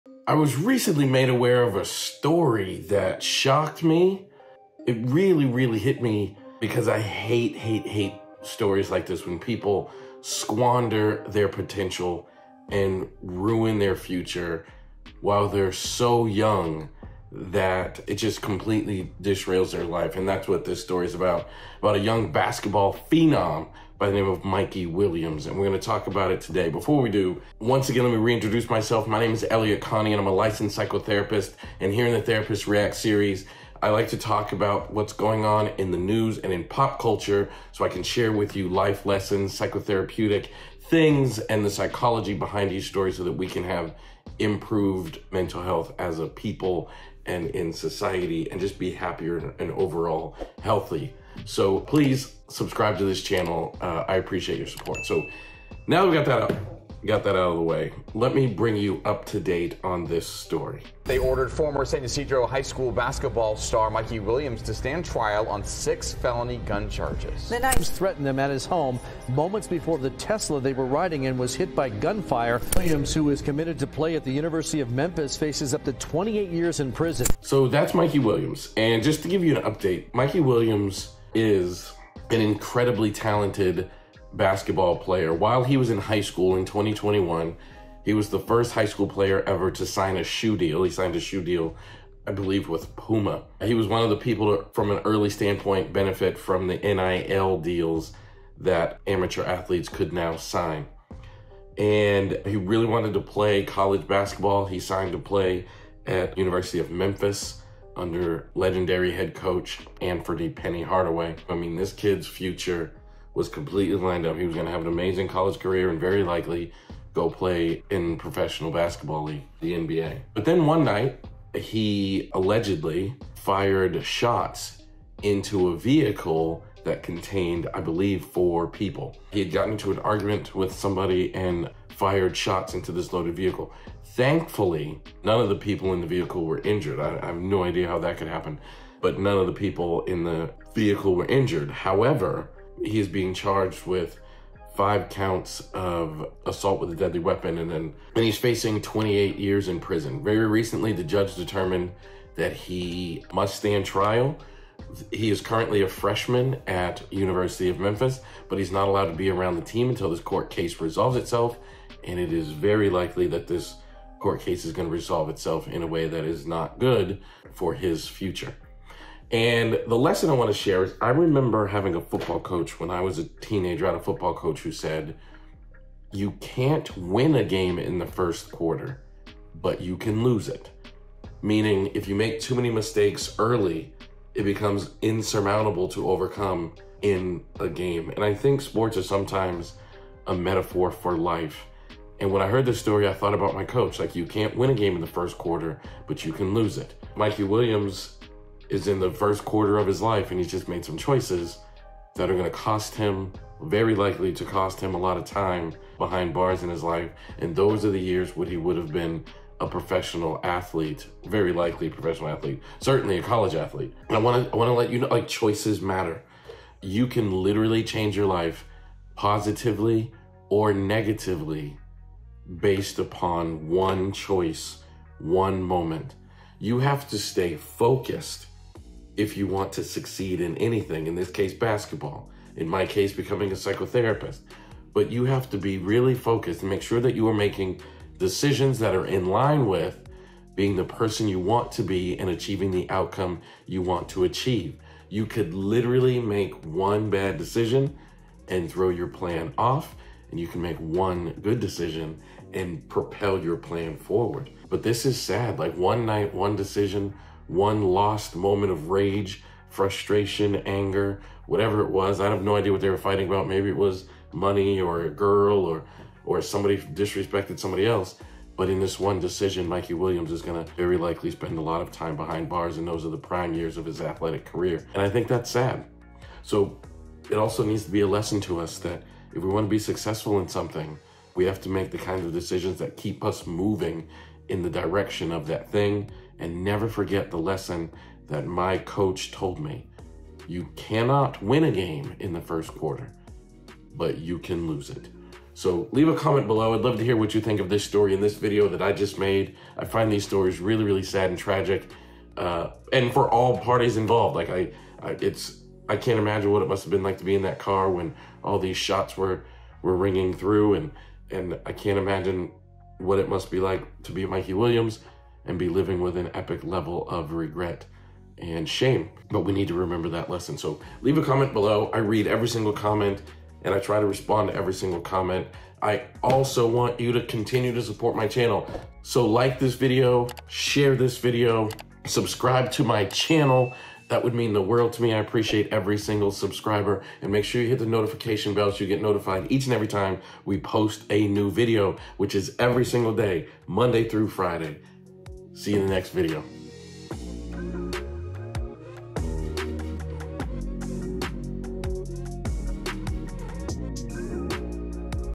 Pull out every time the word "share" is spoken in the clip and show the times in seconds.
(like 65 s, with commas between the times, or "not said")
38 s, 170 s, 330 s.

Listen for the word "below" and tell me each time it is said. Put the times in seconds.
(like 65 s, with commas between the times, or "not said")
296 s, 321 s.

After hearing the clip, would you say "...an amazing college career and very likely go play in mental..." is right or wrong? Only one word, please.
wrong.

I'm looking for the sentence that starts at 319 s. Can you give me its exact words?
But we need to remember that lesson.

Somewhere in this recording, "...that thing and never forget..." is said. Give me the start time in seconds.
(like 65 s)
285 s.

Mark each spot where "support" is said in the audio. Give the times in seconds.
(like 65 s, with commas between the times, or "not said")
54 s, 327 s.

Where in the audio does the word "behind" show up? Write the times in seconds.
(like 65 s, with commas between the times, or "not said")
42 s, 205 s, 272 s.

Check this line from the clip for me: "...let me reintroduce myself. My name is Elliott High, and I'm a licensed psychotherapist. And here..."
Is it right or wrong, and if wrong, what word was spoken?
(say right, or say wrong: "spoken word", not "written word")
wrong: "Connie", not "High".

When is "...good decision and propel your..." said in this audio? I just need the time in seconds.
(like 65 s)
251 s.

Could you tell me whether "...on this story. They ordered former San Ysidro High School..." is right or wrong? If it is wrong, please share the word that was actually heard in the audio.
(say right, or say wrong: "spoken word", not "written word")
right.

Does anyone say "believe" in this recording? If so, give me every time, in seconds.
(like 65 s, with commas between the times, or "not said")
92 s, 127 s.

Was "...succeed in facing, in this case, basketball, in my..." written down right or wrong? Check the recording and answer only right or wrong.
wrong.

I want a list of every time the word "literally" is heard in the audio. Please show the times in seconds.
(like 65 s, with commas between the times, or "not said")
217 s, 245 s.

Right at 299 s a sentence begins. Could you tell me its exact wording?
I find these stories really, really sad and tragic.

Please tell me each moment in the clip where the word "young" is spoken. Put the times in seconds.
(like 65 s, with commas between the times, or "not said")
16 s, 21 s.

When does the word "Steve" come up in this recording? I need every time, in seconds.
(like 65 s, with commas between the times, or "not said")
not said.